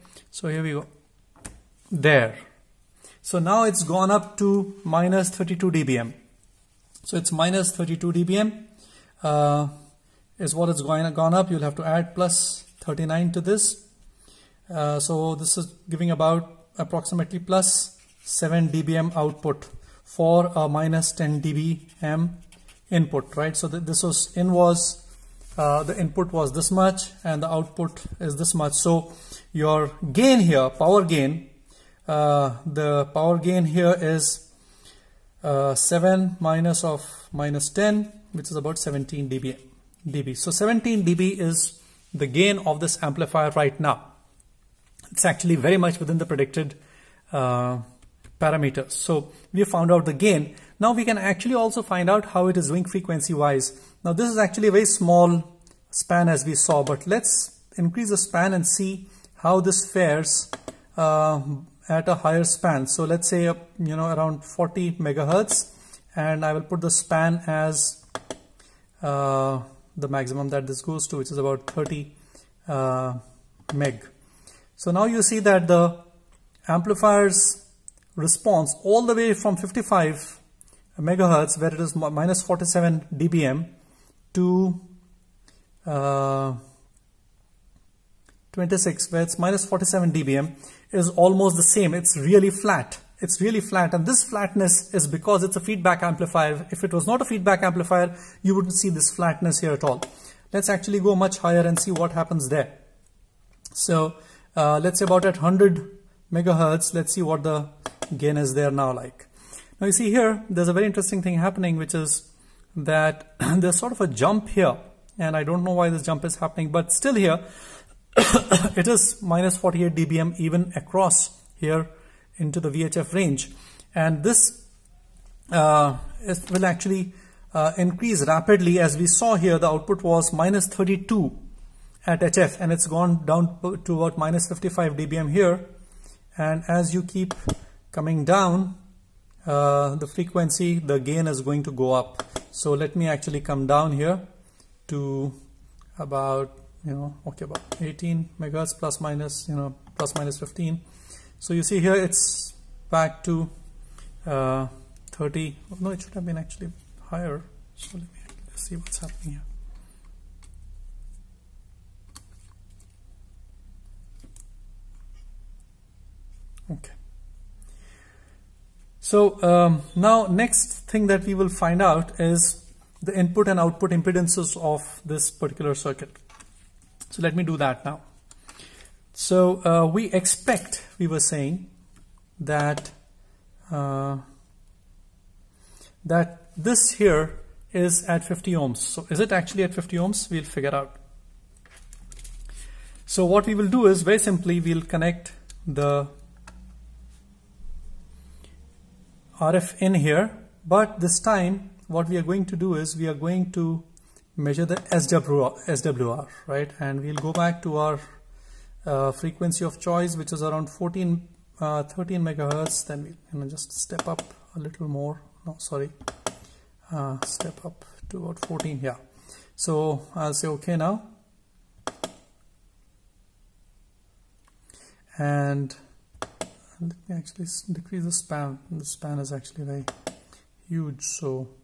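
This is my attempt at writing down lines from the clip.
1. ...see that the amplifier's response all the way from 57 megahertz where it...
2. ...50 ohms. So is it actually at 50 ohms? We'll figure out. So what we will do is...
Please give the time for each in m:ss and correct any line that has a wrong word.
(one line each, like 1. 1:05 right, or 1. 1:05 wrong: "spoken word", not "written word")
1. 1:15 wrong: "55", not "57"
2. 3:08 right.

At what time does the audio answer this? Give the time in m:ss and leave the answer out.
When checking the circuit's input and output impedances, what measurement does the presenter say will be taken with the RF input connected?
3:24.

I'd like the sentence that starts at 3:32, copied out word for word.
Then we can just step up a little more.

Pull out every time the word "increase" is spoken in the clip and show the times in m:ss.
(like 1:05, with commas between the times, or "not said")
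0:57, 2:07.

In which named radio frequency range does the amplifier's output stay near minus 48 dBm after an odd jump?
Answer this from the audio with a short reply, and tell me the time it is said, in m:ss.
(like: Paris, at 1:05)
VHF, at 2:02.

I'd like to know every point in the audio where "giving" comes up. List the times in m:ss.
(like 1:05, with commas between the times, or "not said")
0:15.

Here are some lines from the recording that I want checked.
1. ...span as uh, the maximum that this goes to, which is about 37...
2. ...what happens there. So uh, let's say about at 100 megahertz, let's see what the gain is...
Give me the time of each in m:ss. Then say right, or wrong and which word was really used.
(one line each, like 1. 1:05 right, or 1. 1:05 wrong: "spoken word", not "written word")
1. 1:06 wrong: "30", not "37"
2. 1:41 right.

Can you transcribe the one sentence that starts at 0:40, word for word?
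So 17 dB is the gain of this amplifier right now.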